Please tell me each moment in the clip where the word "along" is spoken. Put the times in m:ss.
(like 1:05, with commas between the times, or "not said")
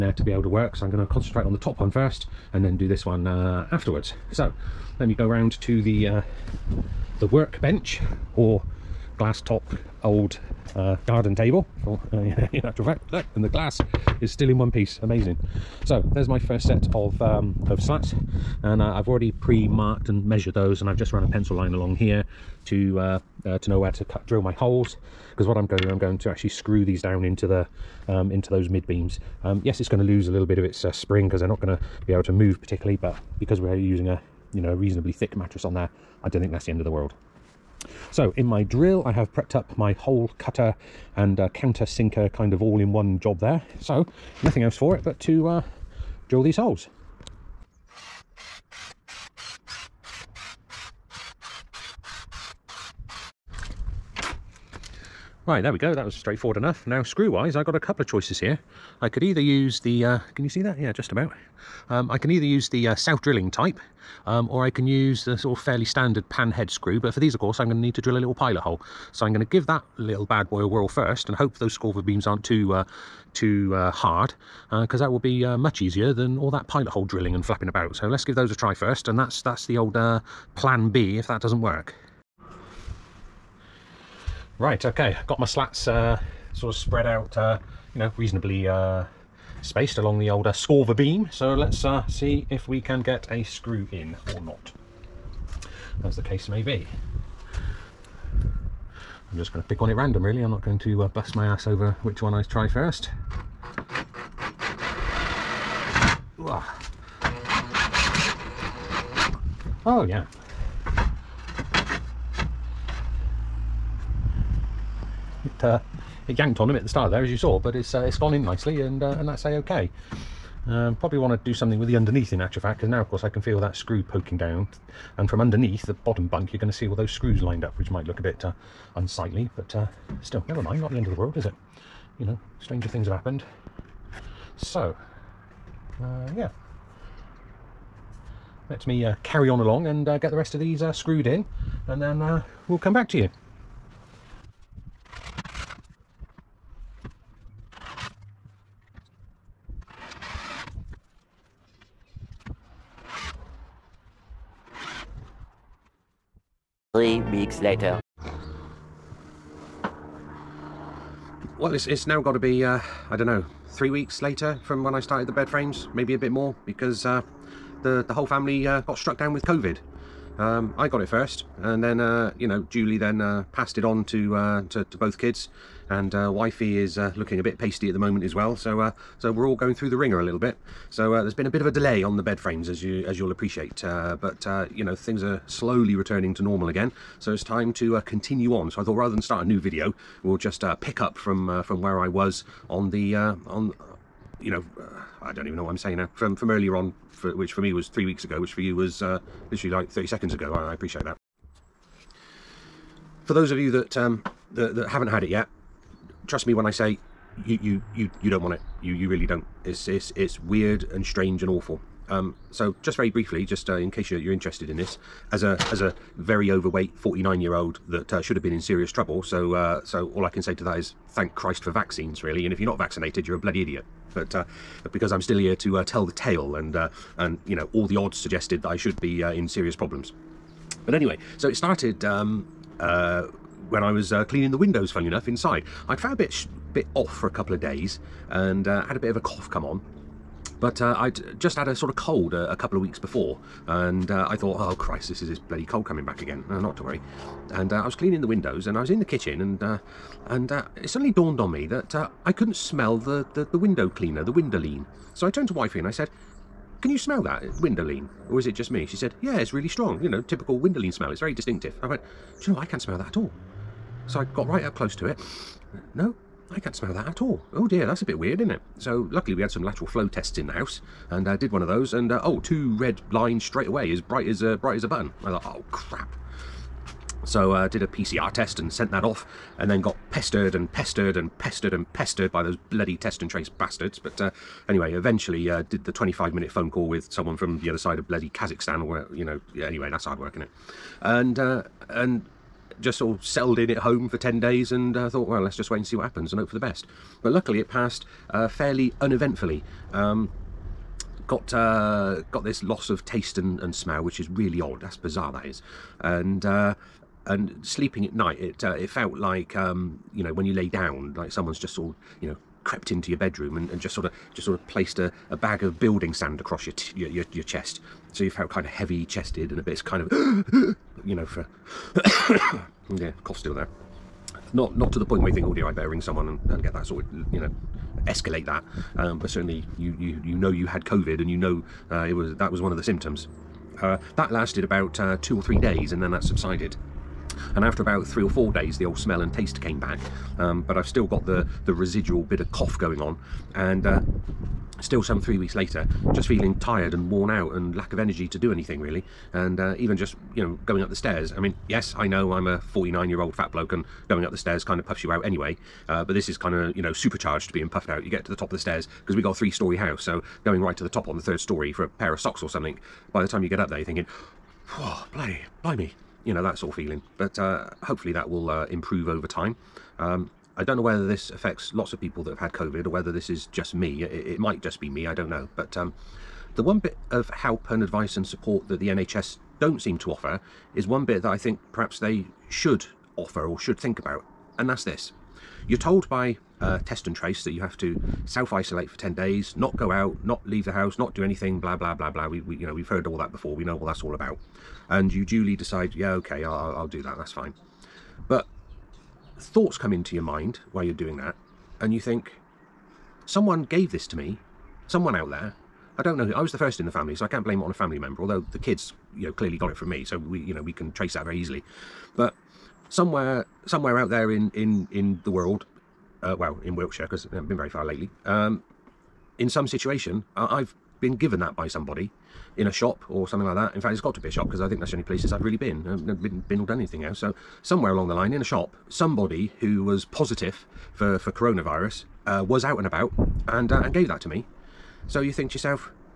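0:21, 1:29, 2:19, 7:07.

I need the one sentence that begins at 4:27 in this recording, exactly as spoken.
Oh dear, that's a bit weird, isn't it?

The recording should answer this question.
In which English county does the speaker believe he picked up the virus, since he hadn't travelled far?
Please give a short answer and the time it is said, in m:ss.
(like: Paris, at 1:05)
Wiltshire, at 6:56.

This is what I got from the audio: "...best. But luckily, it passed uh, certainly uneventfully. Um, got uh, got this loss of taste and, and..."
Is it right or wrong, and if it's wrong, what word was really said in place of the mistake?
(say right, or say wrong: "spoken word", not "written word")
wrong: "fairly", not "certainly".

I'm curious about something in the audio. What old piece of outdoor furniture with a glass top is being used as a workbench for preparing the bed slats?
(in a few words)
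garden table.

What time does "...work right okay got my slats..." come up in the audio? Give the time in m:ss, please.
1:21.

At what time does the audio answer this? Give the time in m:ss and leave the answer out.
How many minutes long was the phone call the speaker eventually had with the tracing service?
4:45.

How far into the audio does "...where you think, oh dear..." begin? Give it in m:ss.
5:25.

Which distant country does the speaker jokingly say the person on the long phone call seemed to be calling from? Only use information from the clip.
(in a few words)
Kazakhstan.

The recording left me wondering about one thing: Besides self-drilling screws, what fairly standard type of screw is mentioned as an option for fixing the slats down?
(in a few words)
pan head screw.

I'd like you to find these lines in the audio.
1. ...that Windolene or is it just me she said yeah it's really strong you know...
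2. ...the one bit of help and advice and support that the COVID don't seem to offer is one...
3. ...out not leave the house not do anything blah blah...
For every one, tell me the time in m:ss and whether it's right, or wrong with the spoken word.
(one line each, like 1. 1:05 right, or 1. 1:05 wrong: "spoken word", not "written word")
1. 4:17 right
2. 6:16 wrong: "NHS", not "COVID"
3. 6:29 right.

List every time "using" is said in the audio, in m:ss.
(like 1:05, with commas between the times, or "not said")
0:33.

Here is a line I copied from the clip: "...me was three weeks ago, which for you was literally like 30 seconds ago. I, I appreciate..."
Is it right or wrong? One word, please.
right.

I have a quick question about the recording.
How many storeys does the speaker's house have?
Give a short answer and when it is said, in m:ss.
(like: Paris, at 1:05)
3, at 5:59.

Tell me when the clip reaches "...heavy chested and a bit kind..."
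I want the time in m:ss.
5:18.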